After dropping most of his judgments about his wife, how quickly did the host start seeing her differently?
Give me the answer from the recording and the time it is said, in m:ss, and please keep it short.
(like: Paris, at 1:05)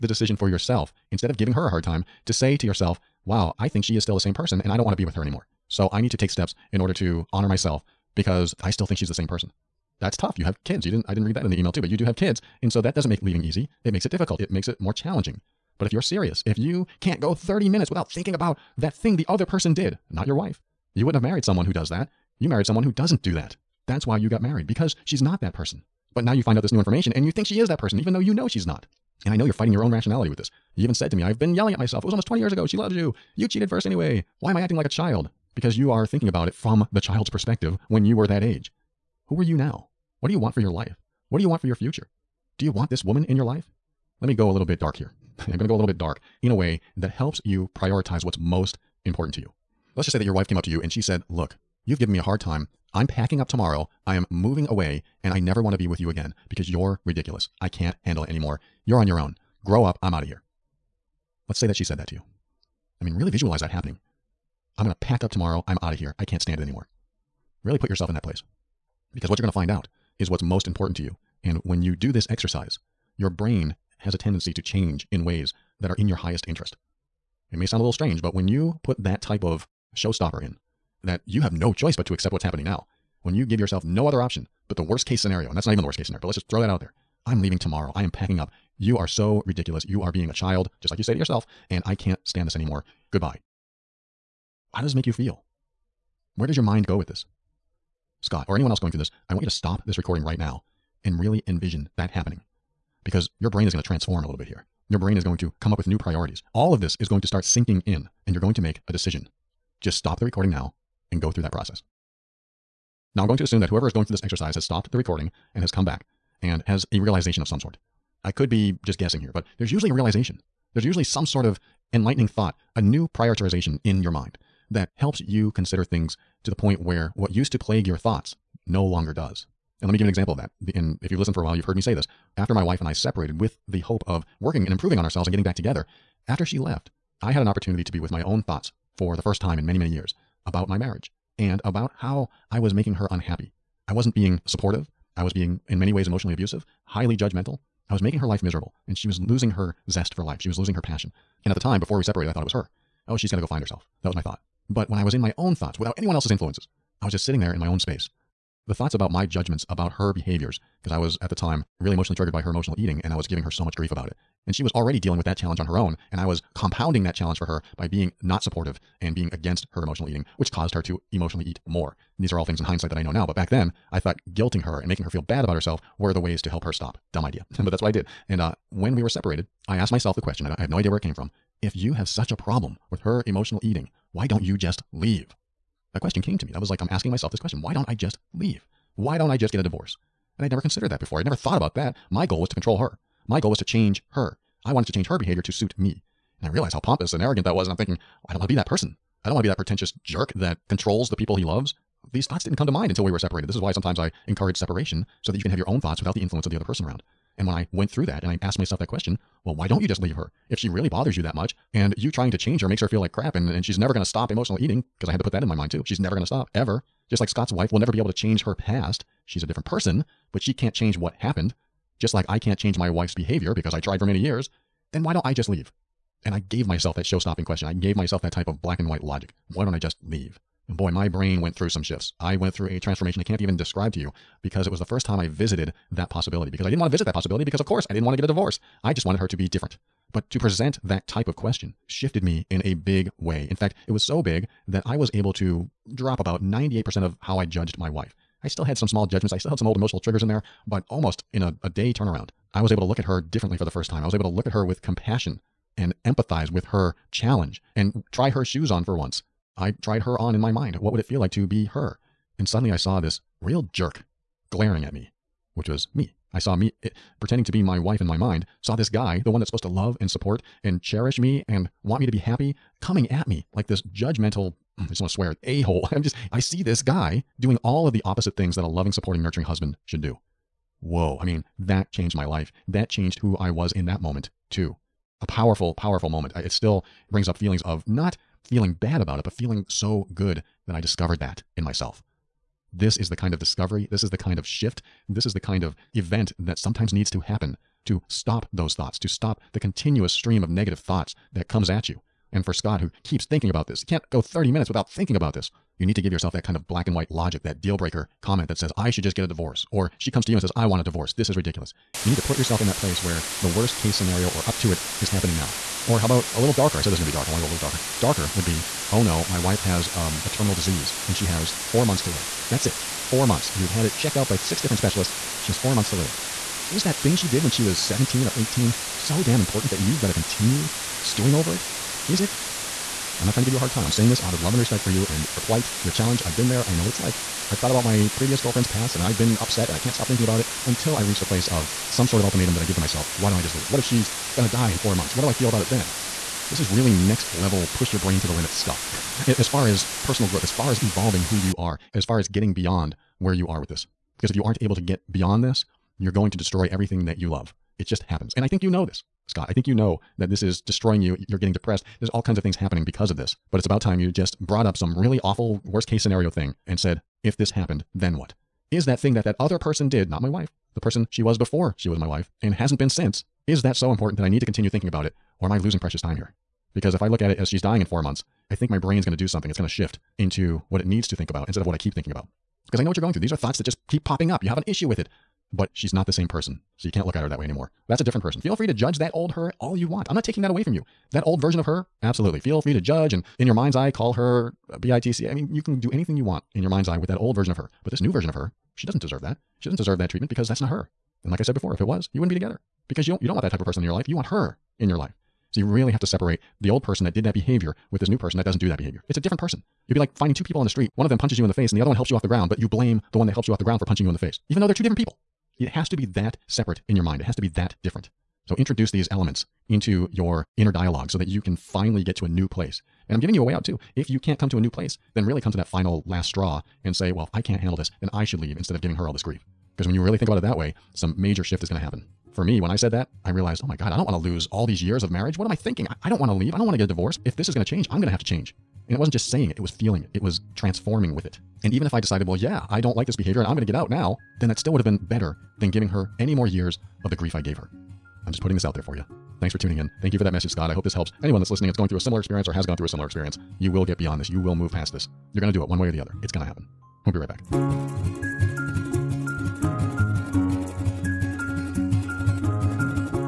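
a day, at 4:11.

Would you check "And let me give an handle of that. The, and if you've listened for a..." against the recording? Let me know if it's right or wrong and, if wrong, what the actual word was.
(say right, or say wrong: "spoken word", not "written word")
wrong: "example", not "handle".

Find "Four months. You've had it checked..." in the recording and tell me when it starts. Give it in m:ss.
5:22.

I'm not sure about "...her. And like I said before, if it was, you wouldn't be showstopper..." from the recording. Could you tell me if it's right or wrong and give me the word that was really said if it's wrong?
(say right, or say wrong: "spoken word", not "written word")
wrong: "together", not "showstopper".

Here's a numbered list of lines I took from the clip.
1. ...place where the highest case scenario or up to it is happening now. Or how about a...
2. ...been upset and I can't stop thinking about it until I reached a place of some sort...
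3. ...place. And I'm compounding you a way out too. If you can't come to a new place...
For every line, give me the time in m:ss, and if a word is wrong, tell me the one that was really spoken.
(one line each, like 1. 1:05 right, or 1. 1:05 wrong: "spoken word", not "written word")
1. 5:12 wrong: "worst", not "highest"
2. 5:39 right
3. 7:02 wrong: "giving", not "compounding".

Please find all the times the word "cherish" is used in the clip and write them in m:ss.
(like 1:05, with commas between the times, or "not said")
4:30.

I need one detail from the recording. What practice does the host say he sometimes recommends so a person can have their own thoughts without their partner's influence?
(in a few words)
separation.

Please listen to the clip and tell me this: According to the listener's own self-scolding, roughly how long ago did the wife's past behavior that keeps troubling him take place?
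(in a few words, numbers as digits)
almost 20 years ago.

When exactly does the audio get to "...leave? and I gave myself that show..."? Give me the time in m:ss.
3:45.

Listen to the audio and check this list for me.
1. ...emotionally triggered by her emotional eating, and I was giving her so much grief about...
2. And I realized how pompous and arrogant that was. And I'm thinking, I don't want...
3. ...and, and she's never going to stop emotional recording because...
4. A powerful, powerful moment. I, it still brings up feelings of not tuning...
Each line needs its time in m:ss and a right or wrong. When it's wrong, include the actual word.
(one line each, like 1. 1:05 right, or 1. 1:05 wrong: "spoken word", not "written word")
1. 2:41 right
2. 3:16 right
3. 3:33 wrong: "eating", not "recording"
4. 4:45 wrong: "feeling", not "tuning".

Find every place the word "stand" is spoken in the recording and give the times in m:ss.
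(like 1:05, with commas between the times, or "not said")
1:06, 1:32.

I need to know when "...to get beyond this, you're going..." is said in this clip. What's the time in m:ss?
5:54.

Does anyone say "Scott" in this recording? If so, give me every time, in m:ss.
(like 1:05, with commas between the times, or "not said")
1:38, 3:37, 5:02, 5:59, 7:30.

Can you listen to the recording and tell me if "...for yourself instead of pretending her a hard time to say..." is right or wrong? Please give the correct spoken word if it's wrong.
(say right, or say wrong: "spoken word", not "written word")
wrong: "giving", not "pretending".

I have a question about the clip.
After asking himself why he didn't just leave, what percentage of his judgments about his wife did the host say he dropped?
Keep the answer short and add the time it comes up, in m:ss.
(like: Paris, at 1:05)
98%, at 4:06.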